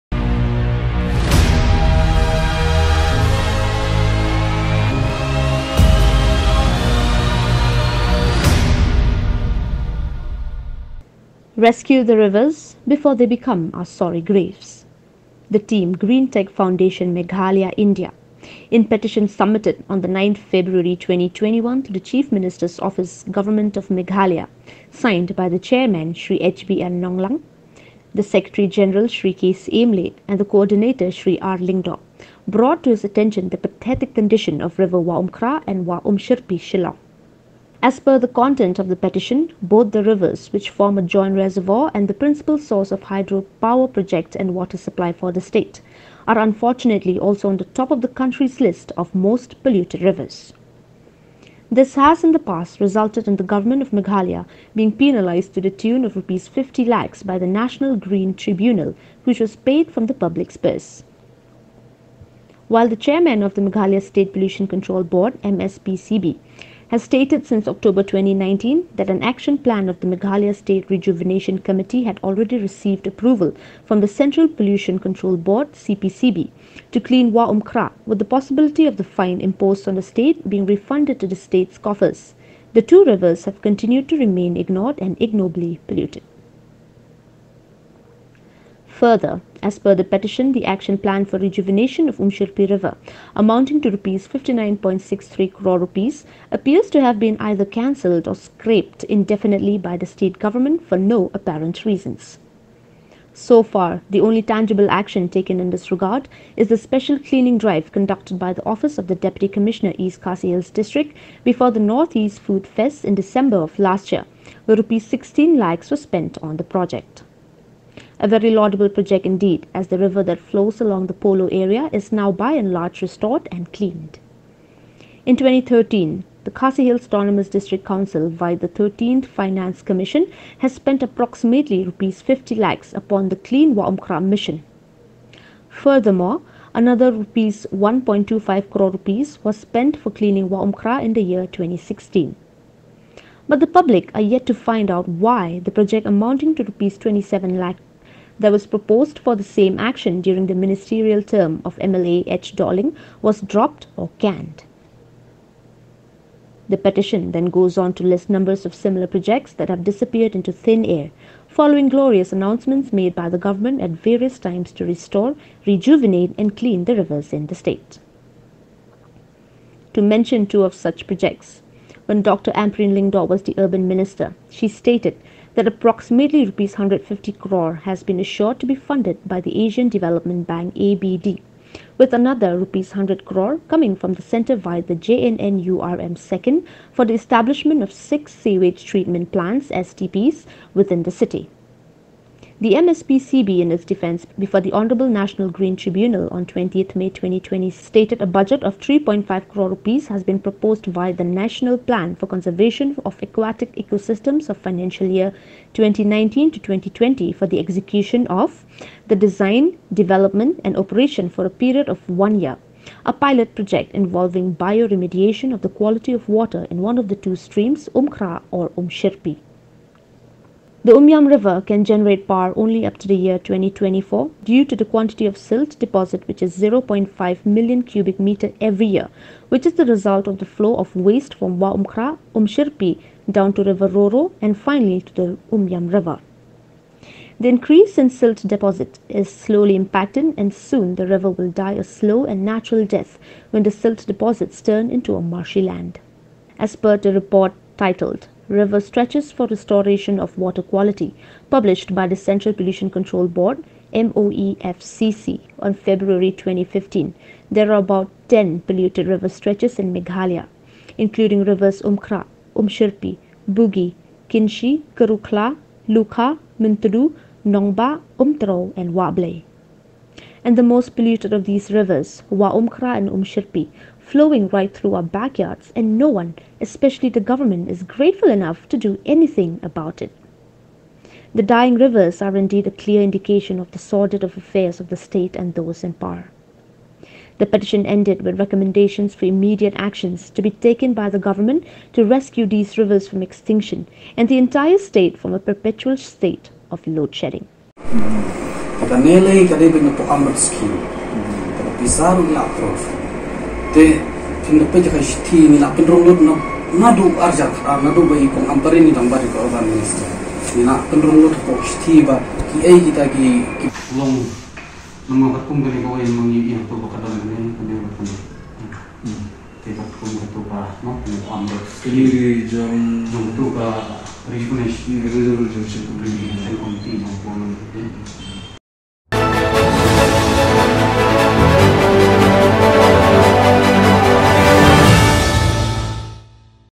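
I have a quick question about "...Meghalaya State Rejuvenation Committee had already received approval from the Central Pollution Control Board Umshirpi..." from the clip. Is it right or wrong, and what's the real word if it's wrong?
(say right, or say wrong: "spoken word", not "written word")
wrong: "CPCB", not "Umshirpi".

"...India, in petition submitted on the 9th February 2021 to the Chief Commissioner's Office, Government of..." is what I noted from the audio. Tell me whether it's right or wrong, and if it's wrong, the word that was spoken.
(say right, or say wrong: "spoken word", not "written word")
wrong: "Minister", not "Commissioner".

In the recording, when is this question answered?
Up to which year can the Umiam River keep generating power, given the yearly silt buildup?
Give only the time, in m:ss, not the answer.
3:43.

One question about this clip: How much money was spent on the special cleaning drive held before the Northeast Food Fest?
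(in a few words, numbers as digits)
Rs 16 lakhs.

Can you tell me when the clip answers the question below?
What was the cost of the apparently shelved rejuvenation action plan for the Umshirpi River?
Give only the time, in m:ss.
1:33.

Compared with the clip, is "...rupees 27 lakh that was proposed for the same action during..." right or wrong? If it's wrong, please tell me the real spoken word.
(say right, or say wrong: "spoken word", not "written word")
right.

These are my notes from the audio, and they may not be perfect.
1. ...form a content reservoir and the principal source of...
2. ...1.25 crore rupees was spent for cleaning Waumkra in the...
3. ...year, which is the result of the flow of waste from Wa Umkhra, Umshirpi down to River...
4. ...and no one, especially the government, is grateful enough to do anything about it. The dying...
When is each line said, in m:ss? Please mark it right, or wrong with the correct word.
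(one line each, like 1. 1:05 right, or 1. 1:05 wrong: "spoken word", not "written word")
1. 0:40 wrong: "joint", not "content"
2. 2:17 right
3. 3:48 right
4. 4:35 right.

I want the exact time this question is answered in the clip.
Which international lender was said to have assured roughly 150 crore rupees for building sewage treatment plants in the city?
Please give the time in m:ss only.
2:59.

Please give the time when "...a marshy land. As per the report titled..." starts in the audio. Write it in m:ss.
4:05.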